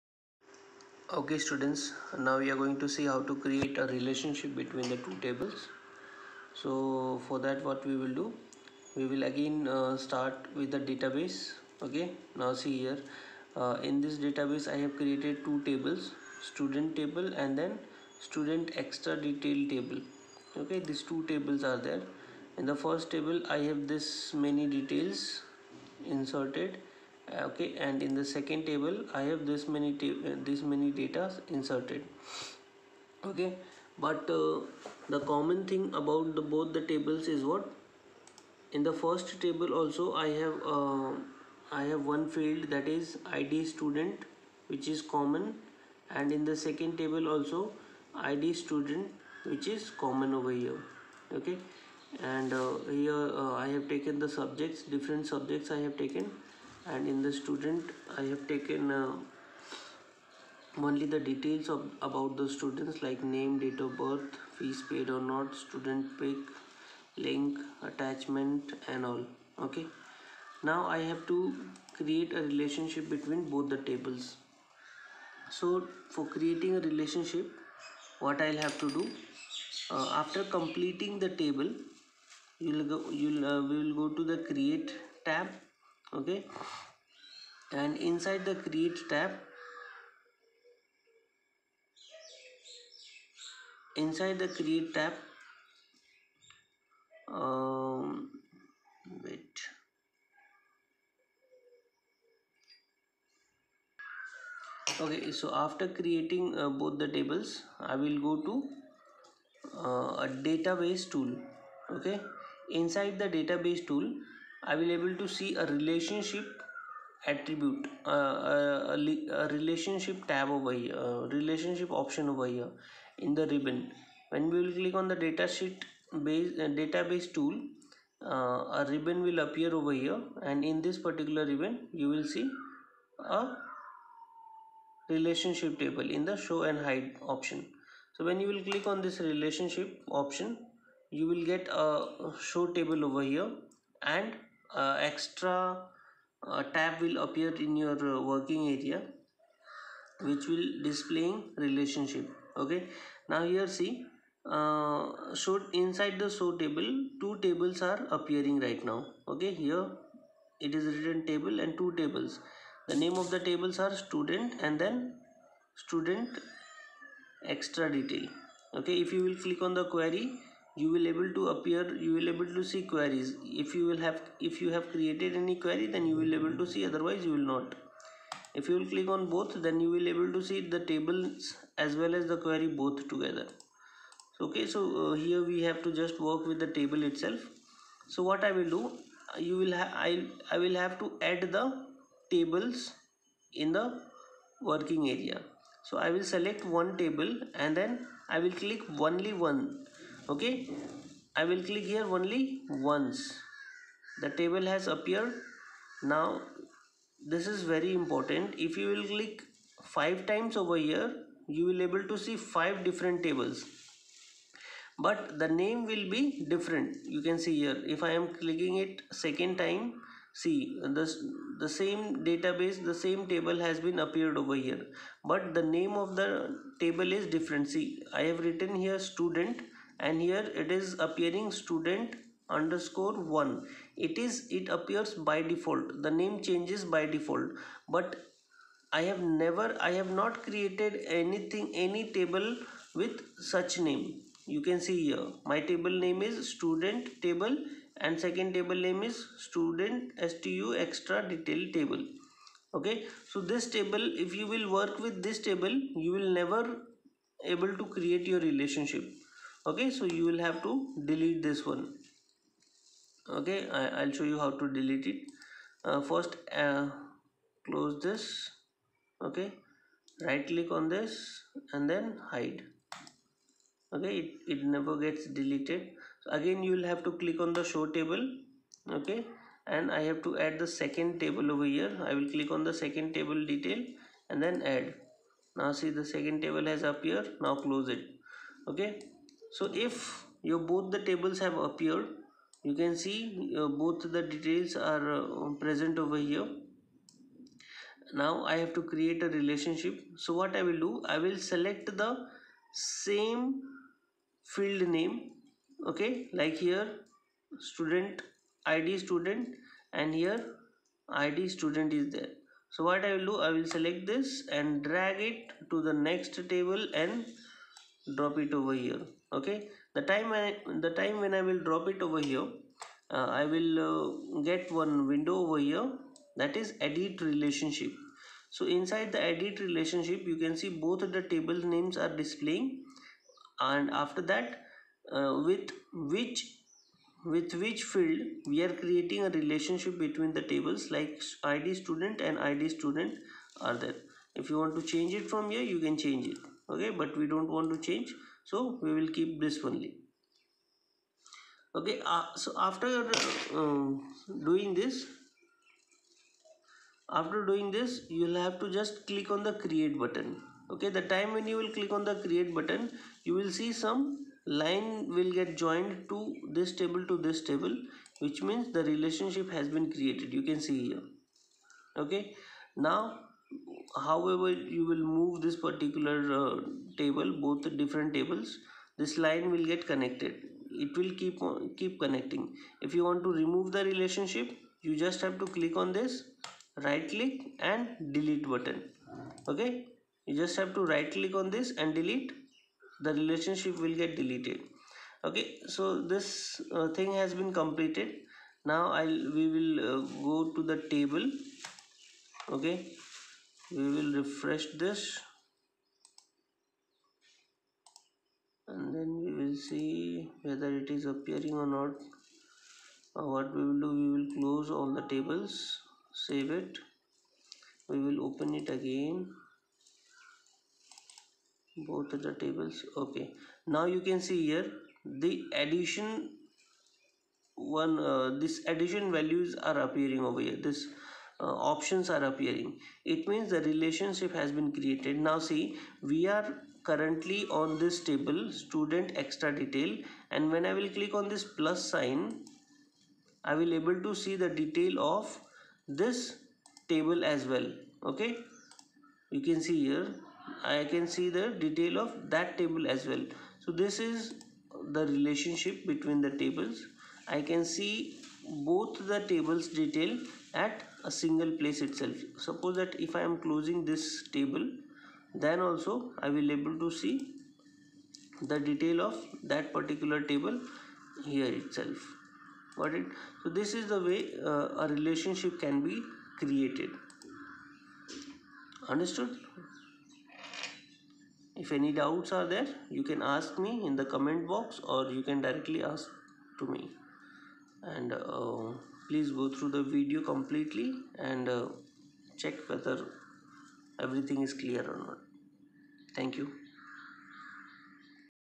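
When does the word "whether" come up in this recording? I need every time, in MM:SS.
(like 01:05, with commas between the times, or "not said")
06:50, 08:12.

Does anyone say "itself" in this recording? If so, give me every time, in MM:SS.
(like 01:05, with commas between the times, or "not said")
03:07, 07:41, 07:51.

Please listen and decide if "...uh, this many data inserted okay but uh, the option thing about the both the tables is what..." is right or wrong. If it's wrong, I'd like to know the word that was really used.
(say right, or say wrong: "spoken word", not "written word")
wrong: "common", not "option".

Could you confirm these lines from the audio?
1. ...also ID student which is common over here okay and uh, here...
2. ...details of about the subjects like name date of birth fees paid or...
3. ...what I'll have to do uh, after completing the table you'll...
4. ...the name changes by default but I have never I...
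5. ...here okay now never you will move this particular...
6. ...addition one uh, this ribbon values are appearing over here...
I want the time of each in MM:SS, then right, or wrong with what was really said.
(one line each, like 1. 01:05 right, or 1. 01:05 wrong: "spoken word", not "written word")
1. 00:47 right
2. 01:01 wrong: "students", not "subjects"
3. 01:18 right
4. 03:56 right
5. 06:10 wrong: "however", not "never"
6. 07:05 wrong: "addition", not "ribbon".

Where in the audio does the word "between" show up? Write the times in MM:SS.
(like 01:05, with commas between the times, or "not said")
00:04, 01:13, 05:39, 07:35.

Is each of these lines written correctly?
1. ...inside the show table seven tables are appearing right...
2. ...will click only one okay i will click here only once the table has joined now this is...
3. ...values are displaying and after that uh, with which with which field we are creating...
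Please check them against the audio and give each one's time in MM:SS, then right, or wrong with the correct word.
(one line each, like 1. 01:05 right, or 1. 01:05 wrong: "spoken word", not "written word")
1. 02:35 wrong: "two", not "seven"
2. 03:18 wrong: "appeared", not "joined"
3. 05:31 wrong: "names", not "values".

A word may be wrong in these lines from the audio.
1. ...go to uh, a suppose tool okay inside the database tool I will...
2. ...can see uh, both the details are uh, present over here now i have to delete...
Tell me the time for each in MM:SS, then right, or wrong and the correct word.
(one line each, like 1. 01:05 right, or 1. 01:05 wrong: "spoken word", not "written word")
1. 01:48 wrong: "database", not "suppose"
2. 04:52 wrong: "create", not "delete".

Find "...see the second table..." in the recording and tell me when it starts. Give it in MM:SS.
04:45.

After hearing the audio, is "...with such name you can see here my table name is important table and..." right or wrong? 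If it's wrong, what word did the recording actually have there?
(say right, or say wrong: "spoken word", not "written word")
wrong: "student", not "important".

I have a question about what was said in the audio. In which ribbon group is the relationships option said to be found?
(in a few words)
Show and hide.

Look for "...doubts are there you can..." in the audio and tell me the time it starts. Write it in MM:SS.
08:01.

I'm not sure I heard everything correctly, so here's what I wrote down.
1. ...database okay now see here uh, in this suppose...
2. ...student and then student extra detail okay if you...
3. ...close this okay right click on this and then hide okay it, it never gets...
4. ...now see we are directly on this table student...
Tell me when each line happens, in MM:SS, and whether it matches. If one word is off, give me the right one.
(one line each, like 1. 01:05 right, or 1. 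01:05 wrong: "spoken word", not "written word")
1. 00:10 wrong: "database", not "suppose"
2. 02:43 right
3. 04:27 right
4. 07:15 wrong: "currently", not "directly".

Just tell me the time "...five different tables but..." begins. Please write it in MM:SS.
03:32.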